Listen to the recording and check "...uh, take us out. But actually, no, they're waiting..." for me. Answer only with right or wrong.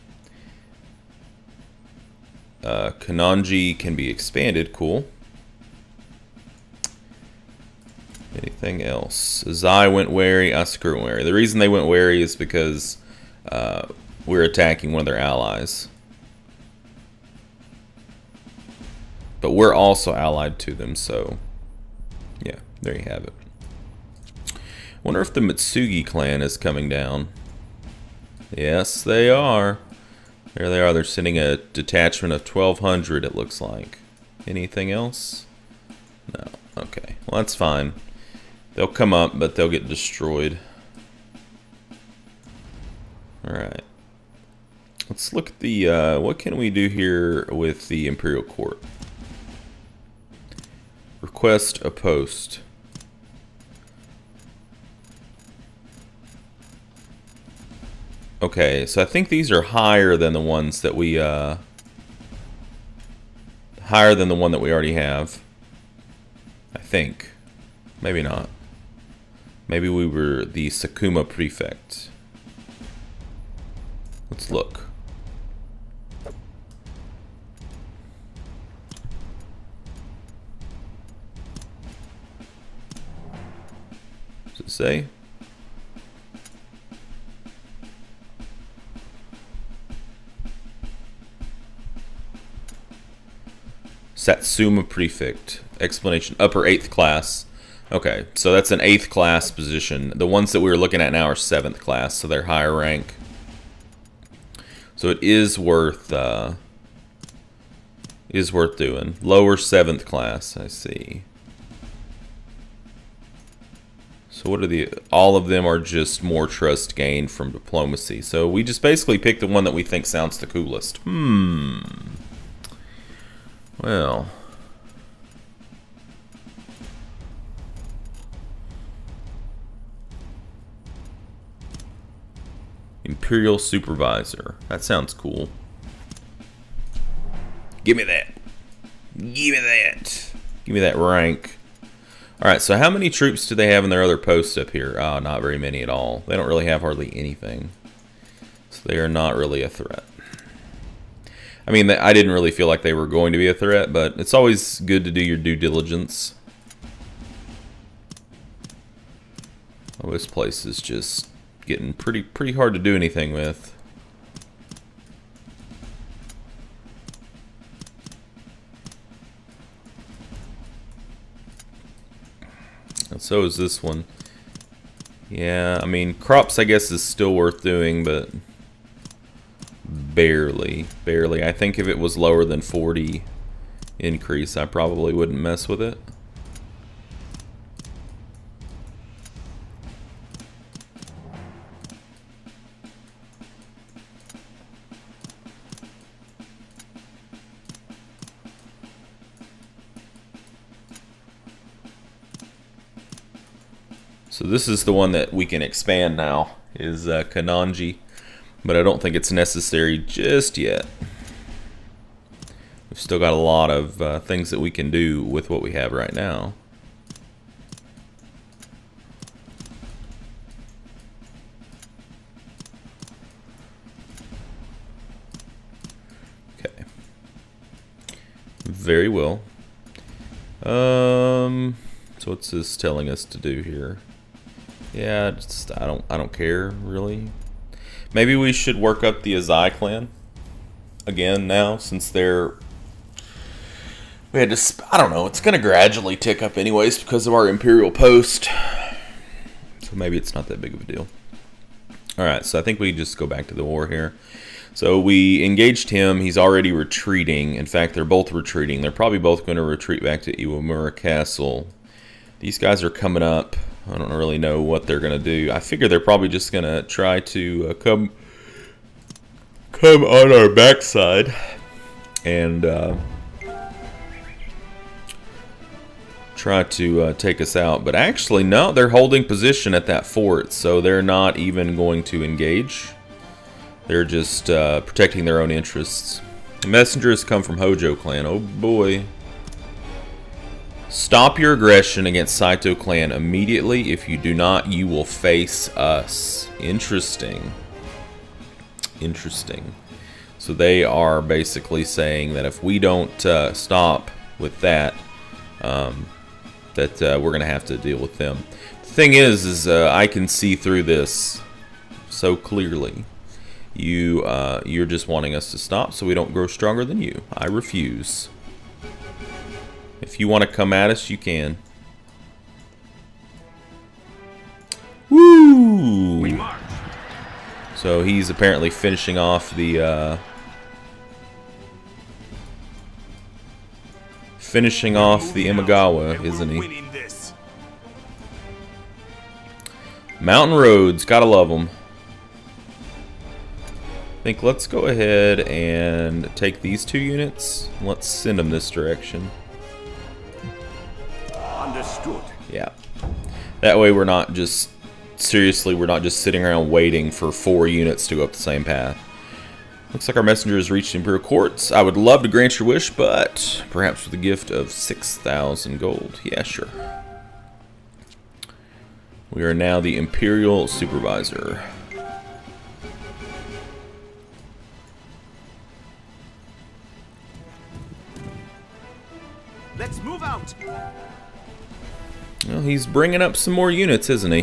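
wrong.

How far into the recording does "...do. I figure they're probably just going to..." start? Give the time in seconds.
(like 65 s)
265 s.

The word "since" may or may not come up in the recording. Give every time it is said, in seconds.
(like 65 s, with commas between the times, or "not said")
241 s.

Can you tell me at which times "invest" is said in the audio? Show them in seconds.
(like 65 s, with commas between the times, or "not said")
not said.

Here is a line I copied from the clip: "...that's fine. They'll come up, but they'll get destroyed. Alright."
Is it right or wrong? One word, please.
right.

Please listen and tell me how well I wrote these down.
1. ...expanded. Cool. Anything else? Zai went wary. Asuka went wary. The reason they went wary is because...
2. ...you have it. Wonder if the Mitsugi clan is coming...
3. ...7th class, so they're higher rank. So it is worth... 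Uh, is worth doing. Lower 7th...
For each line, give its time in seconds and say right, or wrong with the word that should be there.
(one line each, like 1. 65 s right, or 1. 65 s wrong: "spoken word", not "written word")
1. 4 s right
2. 22 s right
3. 101 s right.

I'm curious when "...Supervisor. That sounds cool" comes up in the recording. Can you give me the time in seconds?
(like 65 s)
133 s.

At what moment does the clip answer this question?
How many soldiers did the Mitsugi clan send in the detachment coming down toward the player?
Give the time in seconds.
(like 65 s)
32 s.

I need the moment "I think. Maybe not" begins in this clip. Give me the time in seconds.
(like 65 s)
66 s.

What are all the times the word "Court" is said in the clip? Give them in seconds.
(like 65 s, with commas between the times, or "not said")
48 s, 361 s.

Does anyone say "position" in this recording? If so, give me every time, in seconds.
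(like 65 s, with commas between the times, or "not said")
99 s, 279 s.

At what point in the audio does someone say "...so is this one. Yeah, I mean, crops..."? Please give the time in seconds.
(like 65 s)
173 s.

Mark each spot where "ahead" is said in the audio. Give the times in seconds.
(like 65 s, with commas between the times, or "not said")
344 s.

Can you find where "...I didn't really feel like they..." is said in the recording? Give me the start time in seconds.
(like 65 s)
151 s.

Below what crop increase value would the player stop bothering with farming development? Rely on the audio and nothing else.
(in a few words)
40.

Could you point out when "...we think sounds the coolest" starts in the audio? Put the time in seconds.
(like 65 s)
119 s.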